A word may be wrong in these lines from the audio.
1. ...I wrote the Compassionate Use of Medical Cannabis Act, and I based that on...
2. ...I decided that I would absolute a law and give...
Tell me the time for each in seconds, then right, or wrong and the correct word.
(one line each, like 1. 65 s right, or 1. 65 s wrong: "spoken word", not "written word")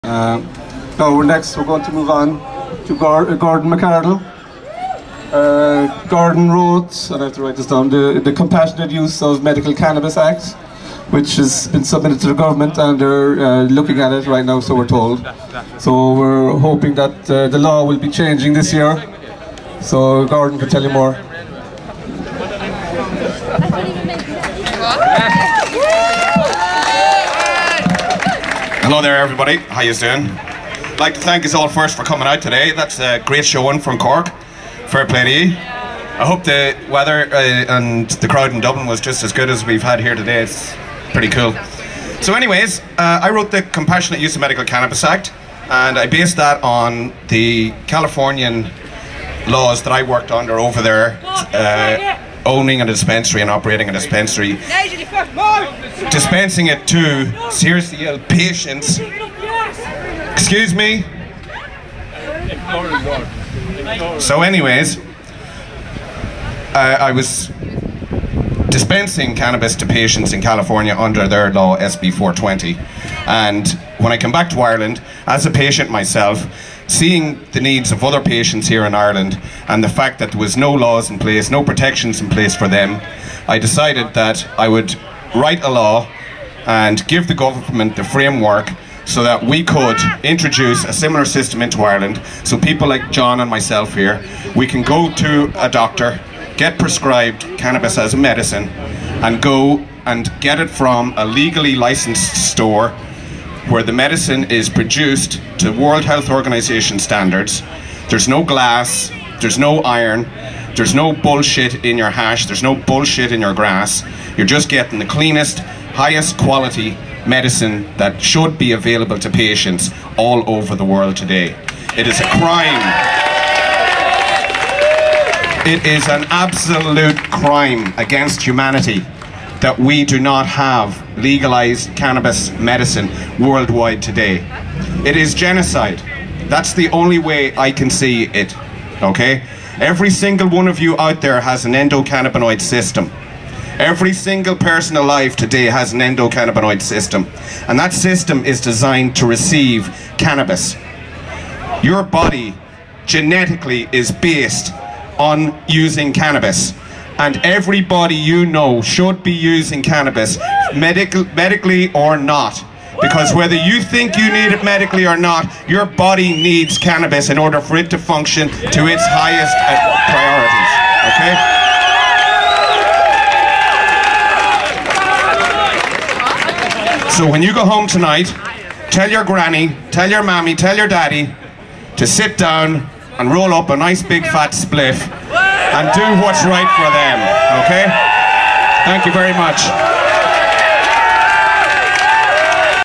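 1. 43 s right
2. 83 s wrong: "write", not "absolute".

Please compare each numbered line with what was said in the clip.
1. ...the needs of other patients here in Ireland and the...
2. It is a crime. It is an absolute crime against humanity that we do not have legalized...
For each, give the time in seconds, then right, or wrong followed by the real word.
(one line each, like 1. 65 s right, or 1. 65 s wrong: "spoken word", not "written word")
1. 77 s right
2. 121 s right.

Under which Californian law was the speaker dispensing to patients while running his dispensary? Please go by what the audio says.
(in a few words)
SB 420.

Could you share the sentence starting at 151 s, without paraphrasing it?
Your body genetically is based on using cannabis and everybody you know should be using cannabis, medic medically or not.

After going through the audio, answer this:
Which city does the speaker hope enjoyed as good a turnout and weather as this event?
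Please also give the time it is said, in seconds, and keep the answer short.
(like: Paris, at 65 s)
Dublin, at 38 s.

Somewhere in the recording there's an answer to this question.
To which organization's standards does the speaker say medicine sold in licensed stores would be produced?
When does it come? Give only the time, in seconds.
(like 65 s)
105 s.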